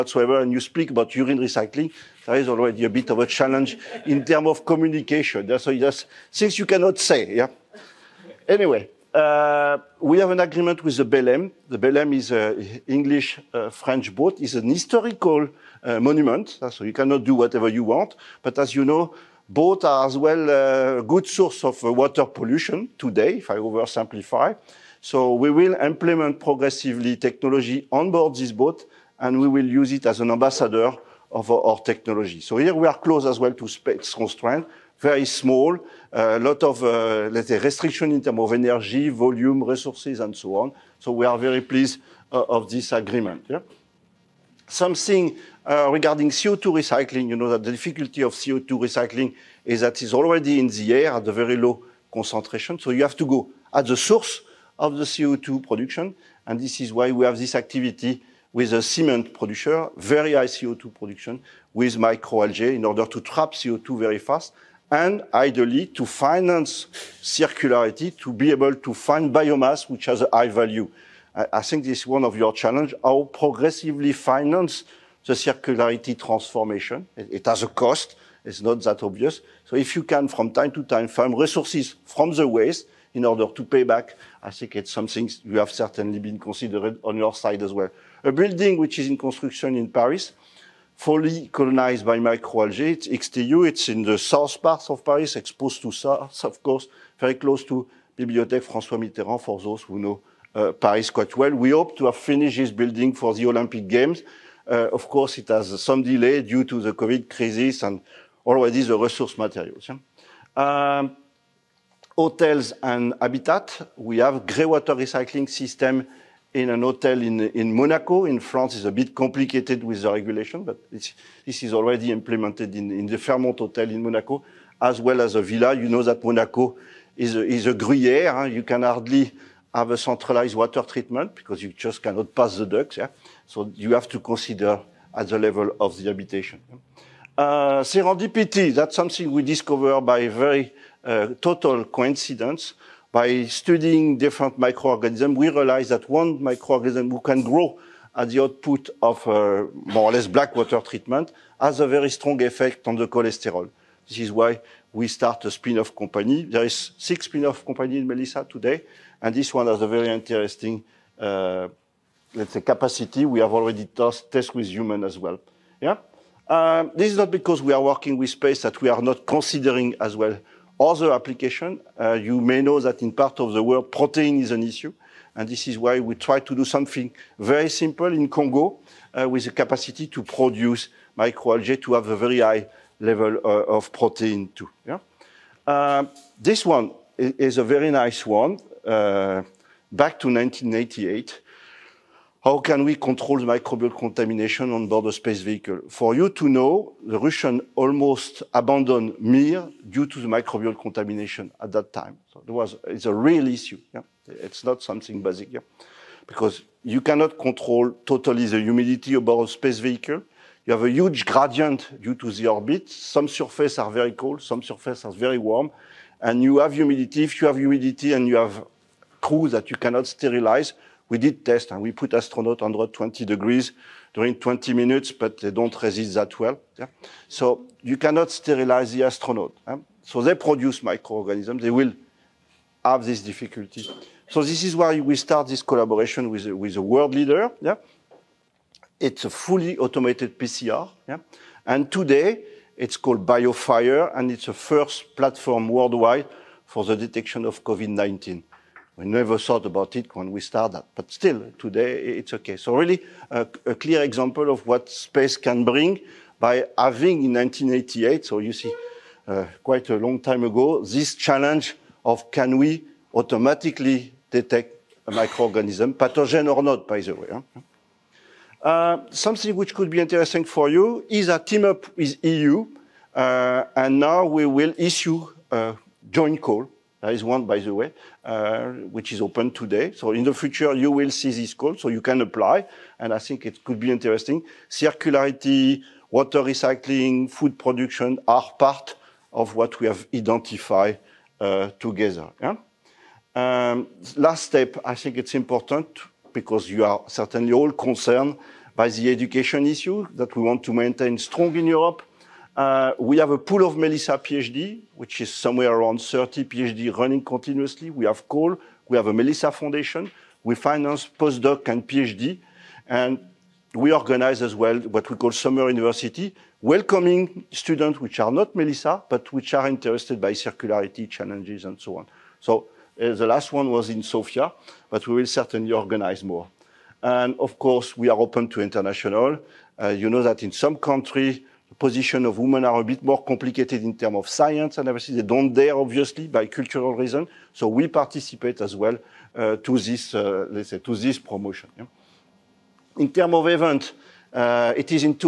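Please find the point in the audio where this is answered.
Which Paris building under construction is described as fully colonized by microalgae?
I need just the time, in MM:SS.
01:33.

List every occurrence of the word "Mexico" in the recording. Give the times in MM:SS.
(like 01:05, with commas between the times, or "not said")
not said.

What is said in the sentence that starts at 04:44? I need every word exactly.
Circularity, water recycling, food production are part of what we have identified uh, together.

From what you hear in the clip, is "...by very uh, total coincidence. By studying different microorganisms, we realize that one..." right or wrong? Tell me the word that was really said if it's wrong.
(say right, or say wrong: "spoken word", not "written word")
right.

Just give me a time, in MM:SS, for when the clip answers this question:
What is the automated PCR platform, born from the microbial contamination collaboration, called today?
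04:03.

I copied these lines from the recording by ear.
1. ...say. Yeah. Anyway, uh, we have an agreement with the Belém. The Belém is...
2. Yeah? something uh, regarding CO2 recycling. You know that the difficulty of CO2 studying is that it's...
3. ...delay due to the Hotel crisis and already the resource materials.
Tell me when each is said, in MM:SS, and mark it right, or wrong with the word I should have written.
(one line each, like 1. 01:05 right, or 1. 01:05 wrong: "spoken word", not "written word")
1. 00:06 right
2. 00:43 wrong: "recycling", not "studying"
3. 01:46 wrong: "COVID", not "Hotel".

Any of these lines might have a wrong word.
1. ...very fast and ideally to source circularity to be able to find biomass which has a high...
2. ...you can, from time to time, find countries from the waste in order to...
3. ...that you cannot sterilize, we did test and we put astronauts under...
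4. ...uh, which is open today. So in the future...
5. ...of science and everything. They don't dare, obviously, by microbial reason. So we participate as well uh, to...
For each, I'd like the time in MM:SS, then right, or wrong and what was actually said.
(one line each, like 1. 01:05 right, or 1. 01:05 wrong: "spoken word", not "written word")
1. 01:03 wrong: "finance", not "source"
2. 01:19 wrong: "resources", not "countries"
3. 03:39 right
4. 04:38 right
5. 05:34 wrong: "cultural", not "microbial".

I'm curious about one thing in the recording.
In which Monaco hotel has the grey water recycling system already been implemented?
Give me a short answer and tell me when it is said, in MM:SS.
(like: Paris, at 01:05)
Fairmont Hotel, at 02:03.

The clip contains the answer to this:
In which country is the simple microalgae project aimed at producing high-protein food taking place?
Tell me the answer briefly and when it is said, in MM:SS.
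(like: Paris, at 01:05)
Congo, at 02:58.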